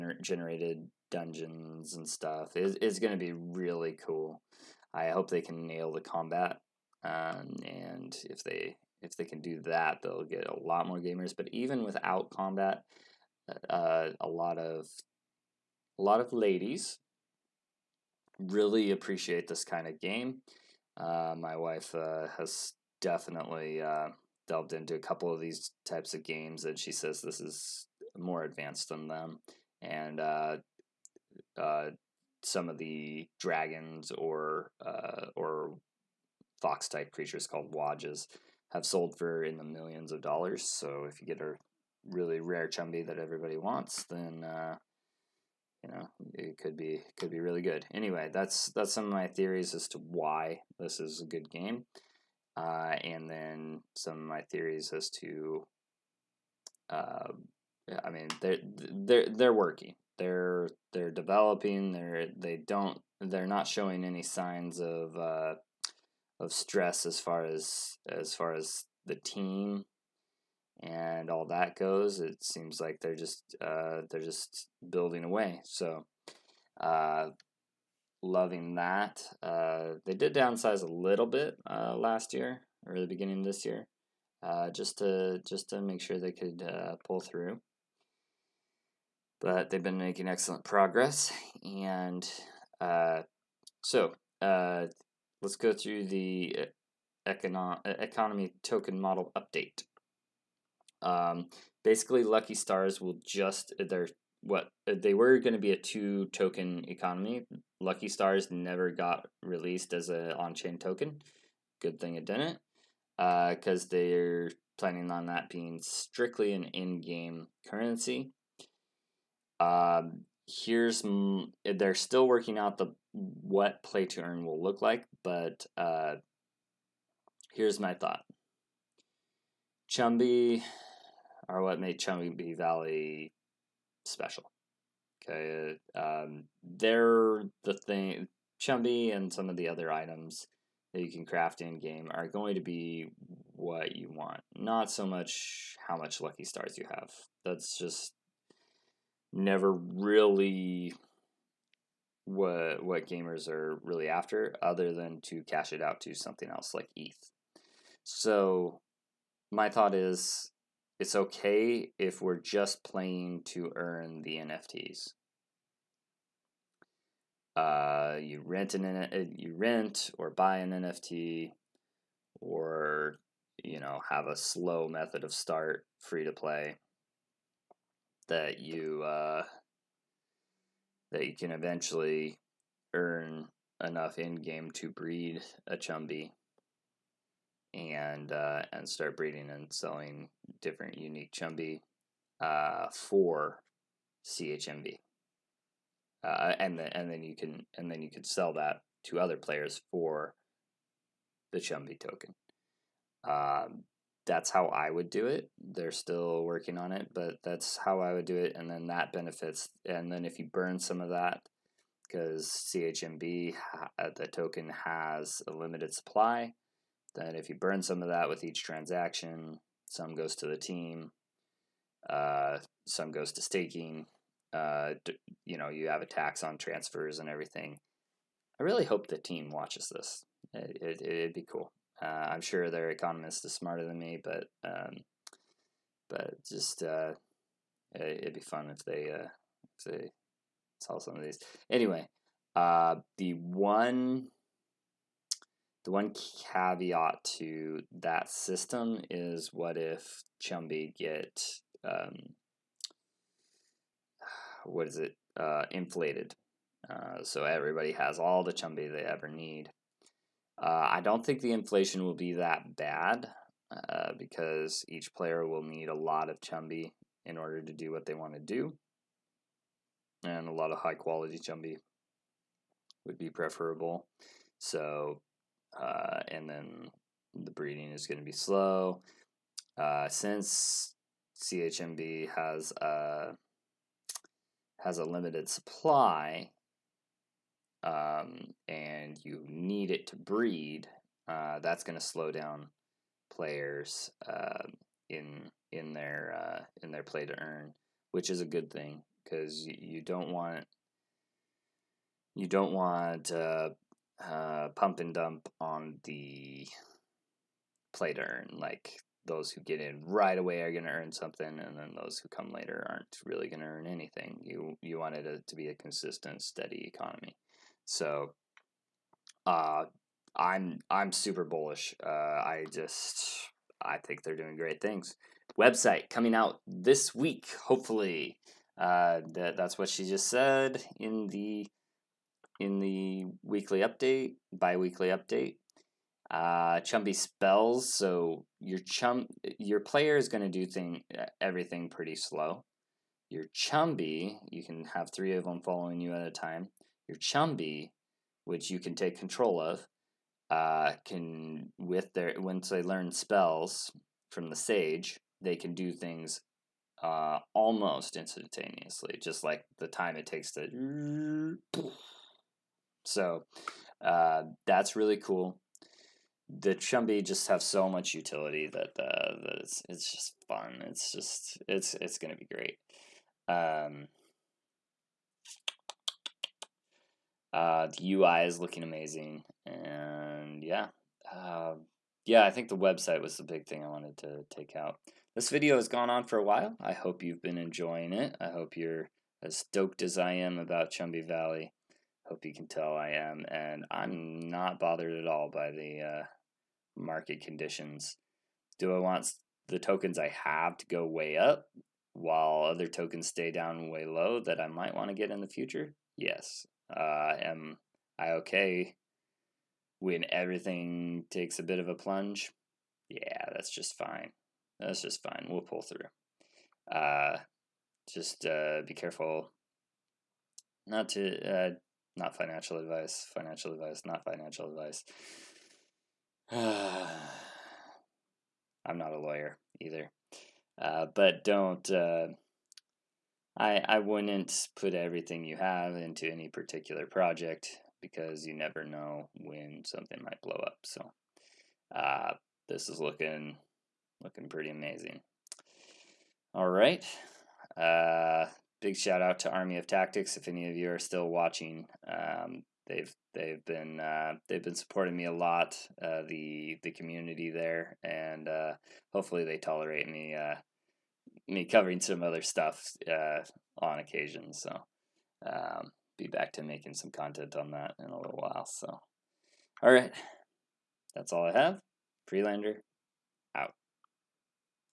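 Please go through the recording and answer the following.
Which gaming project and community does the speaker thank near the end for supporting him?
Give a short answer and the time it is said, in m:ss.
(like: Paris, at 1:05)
Army of Tactics, at 7:29.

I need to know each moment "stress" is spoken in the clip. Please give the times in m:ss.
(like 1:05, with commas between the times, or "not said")
1:06.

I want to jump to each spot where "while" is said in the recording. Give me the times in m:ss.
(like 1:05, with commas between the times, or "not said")
6:26, 6:42, 7:48.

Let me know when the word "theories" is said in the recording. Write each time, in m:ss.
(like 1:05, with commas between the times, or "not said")
0:49, 0:54.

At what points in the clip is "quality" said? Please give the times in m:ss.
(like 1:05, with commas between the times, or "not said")
4:30.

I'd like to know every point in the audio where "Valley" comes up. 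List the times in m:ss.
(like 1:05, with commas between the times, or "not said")
2:12, 6:31.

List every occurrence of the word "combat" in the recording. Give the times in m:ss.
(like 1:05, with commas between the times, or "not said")
0:06, 0:12.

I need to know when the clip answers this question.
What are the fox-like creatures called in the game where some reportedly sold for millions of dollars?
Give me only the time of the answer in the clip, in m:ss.
0:37.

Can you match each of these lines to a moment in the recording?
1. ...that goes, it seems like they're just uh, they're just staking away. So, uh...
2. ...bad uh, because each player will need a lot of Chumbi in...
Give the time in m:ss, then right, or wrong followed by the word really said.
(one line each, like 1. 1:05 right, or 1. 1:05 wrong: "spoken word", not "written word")
1. 1:11 wrong: "building", not "staking"
2. 4:22 right.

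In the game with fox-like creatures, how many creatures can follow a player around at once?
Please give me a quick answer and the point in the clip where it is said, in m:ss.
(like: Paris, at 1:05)
3, at 5:45.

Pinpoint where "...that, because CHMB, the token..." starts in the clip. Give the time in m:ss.
3:31.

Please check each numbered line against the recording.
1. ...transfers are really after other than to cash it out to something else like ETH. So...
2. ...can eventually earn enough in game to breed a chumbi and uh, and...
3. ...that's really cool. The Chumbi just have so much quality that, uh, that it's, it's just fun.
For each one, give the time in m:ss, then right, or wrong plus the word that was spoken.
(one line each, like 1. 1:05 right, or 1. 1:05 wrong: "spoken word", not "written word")
1. 2:33 wrong: "gamers", not "transfers"
2. 3:01 right
3. 6:04 wrong: "utility", not "quality".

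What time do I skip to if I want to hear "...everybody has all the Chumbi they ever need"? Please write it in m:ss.
4:17.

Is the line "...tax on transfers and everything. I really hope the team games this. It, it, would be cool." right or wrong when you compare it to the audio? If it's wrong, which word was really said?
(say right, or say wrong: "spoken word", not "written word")
wrong: "watches", not "games".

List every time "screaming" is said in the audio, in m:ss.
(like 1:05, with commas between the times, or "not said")
not said.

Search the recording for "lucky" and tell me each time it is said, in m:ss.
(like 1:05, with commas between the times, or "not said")
1:42, 1:47, 2:26.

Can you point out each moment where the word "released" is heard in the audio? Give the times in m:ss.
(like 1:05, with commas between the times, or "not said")
1:49.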